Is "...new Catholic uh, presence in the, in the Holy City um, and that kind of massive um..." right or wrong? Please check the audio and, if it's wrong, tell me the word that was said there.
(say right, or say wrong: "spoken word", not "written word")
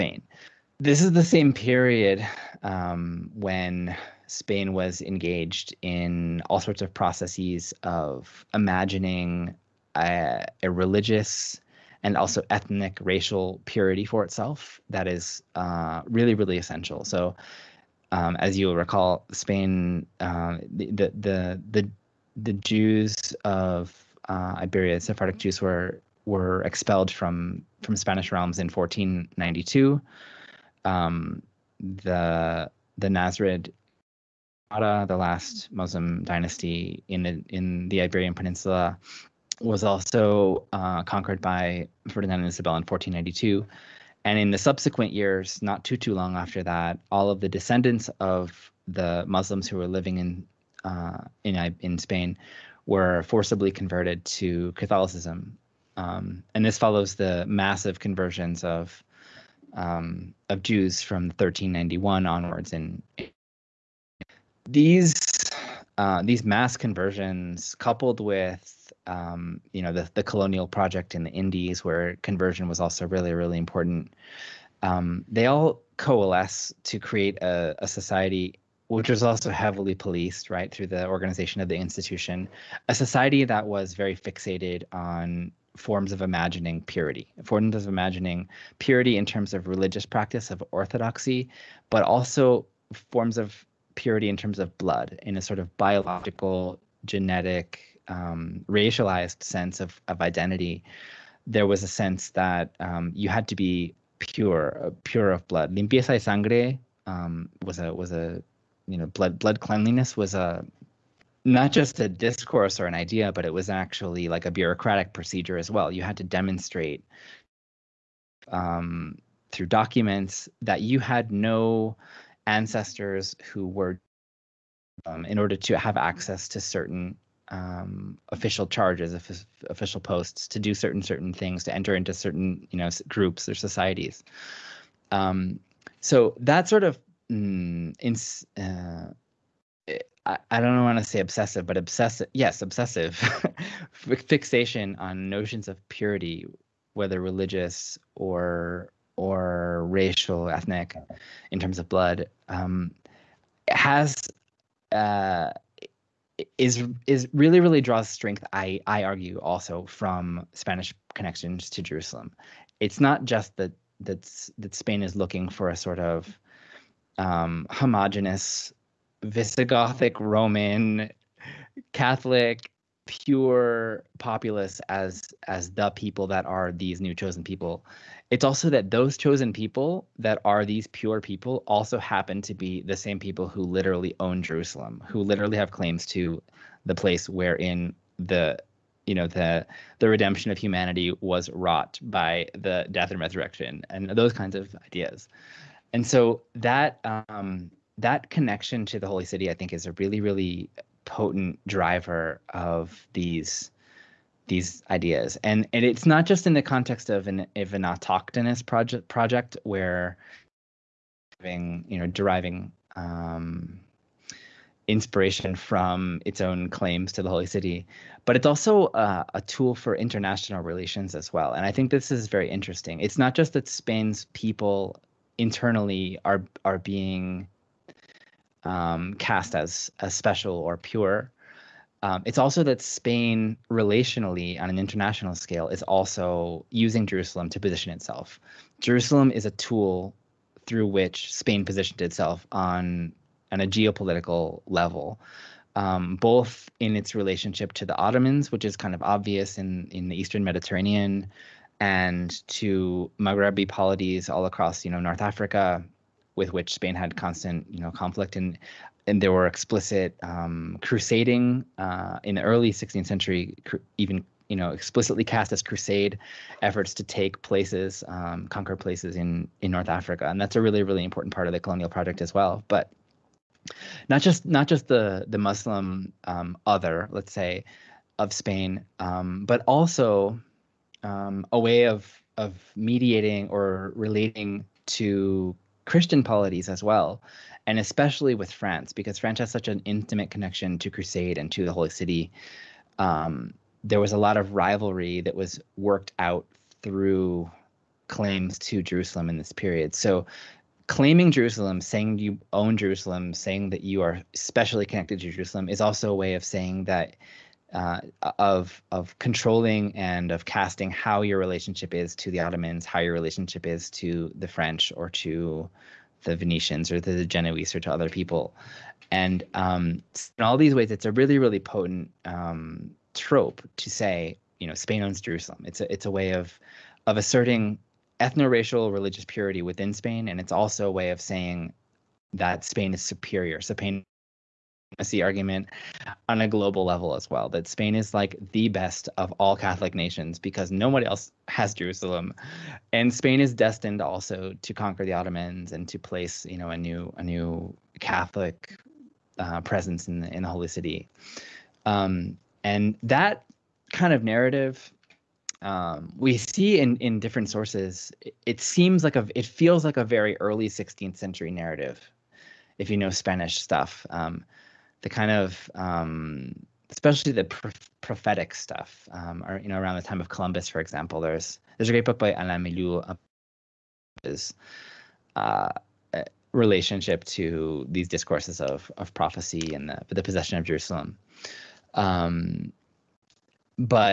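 wrong: "narrative", not "massive".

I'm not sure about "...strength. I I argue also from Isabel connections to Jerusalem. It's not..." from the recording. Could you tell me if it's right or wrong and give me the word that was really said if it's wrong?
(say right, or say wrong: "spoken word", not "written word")
wrong: "Spanish", not "Isabel".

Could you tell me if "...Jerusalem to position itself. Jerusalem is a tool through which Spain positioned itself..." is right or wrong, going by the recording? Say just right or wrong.
right.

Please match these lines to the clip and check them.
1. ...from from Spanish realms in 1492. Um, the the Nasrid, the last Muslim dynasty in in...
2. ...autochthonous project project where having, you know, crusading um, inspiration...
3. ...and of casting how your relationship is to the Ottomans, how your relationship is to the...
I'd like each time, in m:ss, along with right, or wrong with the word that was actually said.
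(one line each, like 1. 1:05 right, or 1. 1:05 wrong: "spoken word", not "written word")
1. 0:27 right
2. 3:27 wrong: "deriving", not "crusading"
3. 5:09 right.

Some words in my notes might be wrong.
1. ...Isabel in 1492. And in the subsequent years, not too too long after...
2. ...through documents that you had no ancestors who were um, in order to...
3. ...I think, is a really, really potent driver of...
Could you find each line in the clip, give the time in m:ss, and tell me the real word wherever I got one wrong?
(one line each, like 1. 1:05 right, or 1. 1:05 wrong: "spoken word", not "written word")
1. 0:42 right
2. 1:59 right
3. 3:19 right.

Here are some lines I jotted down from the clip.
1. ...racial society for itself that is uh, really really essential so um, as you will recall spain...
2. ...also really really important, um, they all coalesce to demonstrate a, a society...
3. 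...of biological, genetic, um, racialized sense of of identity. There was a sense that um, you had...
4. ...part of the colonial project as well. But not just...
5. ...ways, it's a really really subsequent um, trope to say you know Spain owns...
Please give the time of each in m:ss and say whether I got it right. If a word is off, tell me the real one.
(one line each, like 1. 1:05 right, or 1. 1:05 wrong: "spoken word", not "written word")
1. 0:13 wrong: "purity", not "society"
2. 1:12 wrong: "create", not "demonstrate"
3. 1:35 right
4. 4:31 right
5. 5:20 wrong: "potent", not "subsequent".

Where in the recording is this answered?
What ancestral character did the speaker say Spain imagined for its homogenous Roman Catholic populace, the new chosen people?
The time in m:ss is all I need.
2:49.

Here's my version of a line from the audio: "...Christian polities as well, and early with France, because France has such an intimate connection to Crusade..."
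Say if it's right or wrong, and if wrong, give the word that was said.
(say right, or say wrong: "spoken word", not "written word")
wrong: "especially", not "early".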